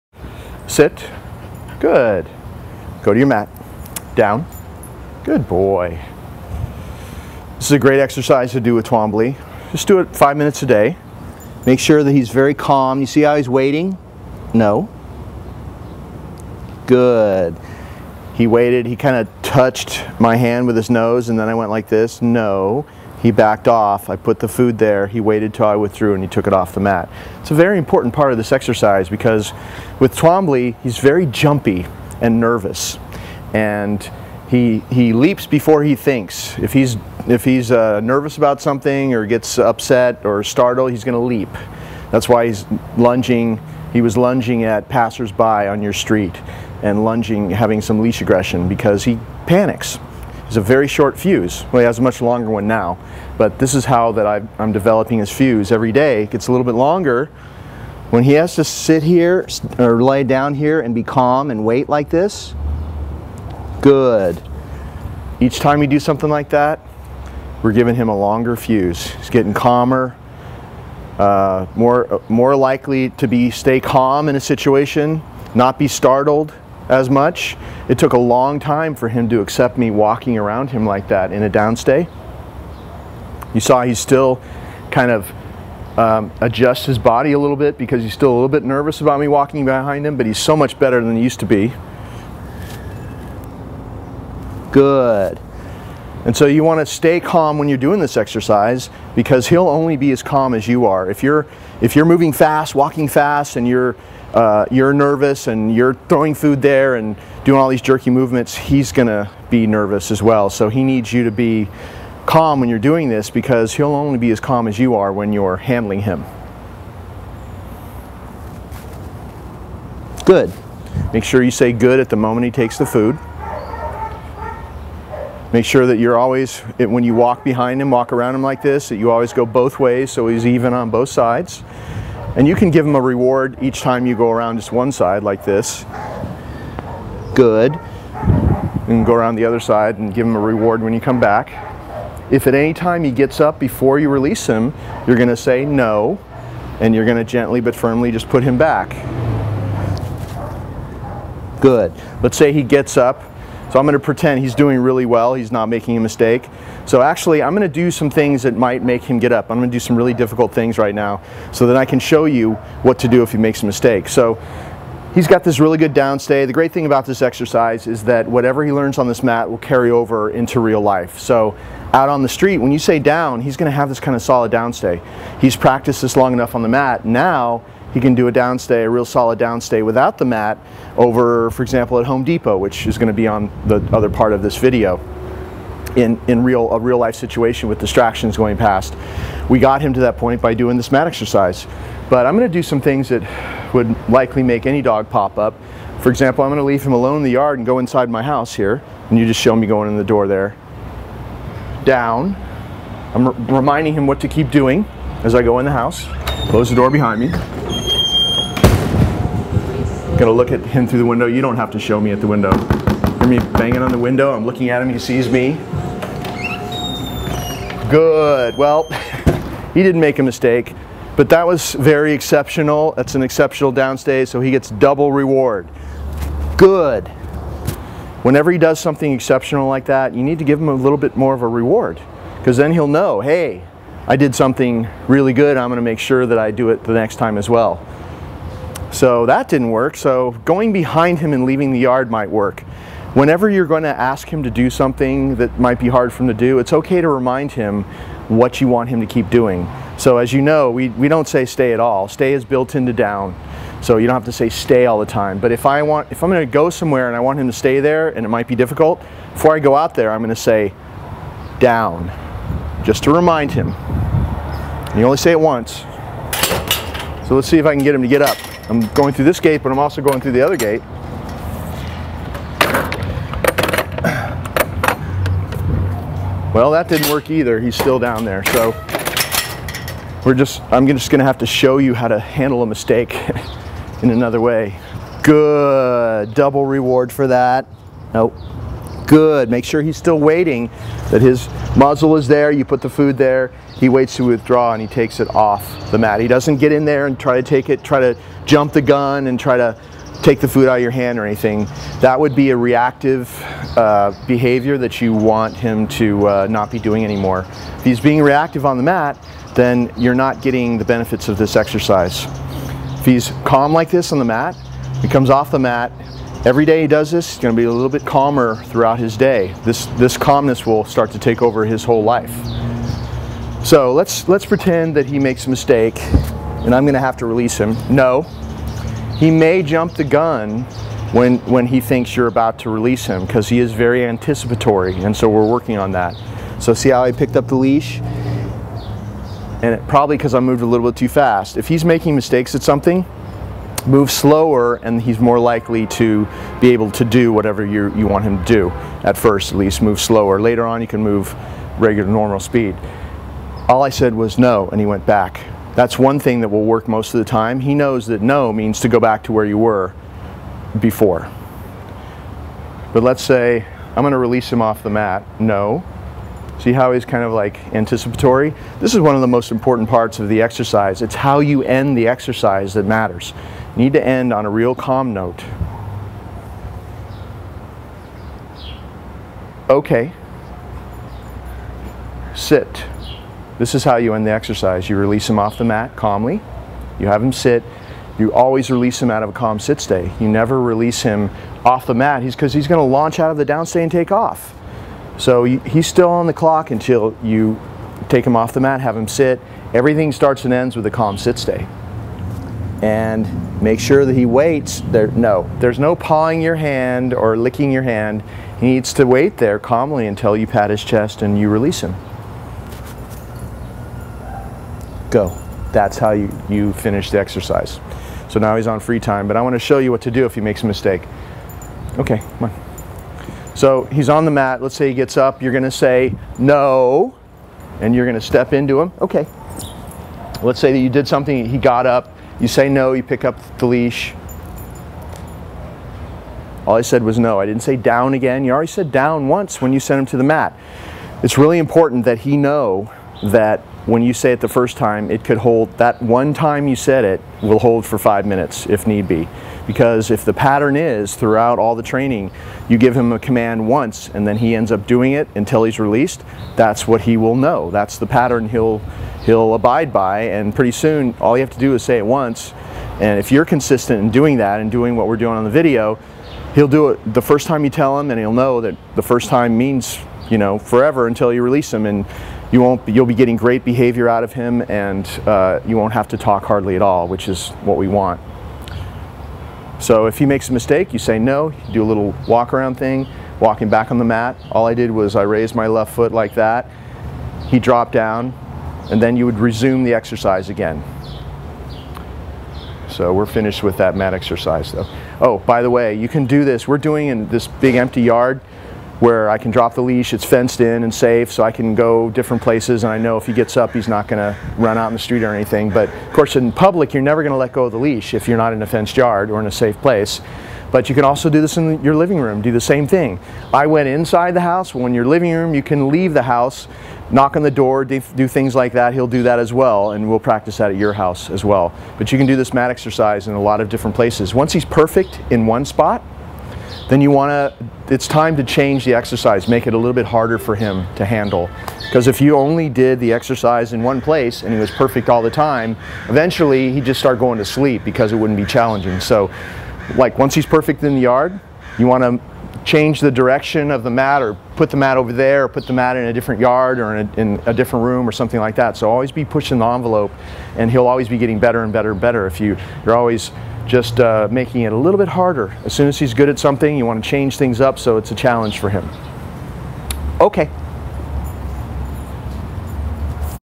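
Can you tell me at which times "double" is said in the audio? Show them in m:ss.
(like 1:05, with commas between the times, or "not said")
3:44, 4:46.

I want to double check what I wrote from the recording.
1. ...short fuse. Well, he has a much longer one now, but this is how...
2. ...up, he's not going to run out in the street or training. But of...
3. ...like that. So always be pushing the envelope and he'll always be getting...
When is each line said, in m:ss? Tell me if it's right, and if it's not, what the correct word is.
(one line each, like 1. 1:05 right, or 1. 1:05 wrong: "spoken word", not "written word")
1. 0:50 right
2. 8:23 wrong: "anything", not "training"
3. 9:08 right.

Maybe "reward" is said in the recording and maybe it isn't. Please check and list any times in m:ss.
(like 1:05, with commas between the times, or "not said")
2:13, 2:20, 3:45, 3:51, 4:46.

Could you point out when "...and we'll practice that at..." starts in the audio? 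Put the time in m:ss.
8:39.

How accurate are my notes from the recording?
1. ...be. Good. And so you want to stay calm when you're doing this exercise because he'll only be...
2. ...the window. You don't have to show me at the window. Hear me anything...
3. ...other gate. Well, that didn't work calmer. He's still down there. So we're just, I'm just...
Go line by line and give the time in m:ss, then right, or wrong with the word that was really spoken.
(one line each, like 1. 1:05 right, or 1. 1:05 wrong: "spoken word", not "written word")
1. 1:31 right
2. 3:30 wrong: "banging", not "anything"
3. 4:30 wrong: "either", not "calmer".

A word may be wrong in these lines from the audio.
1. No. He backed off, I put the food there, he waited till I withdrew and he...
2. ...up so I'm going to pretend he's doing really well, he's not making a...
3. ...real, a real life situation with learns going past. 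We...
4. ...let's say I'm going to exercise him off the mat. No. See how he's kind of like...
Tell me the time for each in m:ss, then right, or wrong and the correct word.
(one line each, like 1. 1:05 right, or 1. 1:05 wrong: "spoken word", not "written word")
1. 0:22 right
2. 2:32 right
3. 3:06 wrong: "distractions", not "learns"
4. 6:03 wrong: "release", not "exercise".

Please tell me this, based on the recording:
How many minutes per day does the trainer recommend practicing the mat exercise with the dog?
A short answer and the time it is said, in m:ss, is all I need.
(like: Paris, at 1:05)
5, at 0:10.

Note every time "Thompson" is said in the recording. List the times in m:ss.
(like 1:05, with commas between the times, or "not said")
not said.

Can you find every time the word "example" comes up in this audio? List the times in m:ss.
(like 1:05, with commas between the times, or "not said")
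3:01, 3:16.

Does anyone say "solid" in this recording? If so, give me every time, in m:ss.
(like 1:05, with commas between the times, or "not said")
2:54, 2:59.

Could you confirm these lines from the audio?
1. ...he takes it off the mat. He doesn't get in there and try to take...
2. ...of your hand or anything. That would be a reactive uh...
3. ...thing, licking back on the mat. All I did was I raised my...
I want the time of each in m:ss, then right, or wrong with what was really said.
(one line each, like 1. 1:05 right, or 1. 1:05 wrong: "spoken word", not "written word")
1. 4:54 right
2. 5:00 right
3. 8:02 wrong: "walking", not "licking".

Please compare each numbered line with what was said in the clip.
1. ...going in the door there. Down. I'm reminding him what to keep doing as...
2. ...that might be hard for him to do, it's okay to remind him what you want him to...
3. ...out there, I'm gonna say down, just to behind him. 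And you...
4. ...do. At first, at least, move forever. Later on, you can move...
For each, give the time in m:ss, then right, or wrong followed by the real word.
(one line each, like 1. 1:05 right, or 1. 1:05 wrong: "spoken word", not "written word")
1. 3:19 right
2. 4:05 right
3. 4:19 wrong: "remind", not "behind"
4. 5:48 wrong: "slower", not "forever".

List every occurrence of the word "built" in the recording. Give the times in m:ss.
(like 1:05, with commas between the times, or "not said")
4:12.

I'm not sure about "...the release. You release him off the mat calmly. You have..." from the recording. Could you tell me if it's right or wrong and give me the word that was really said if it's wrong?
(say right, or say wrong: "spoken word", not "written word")
wrong: "exercise", not "release".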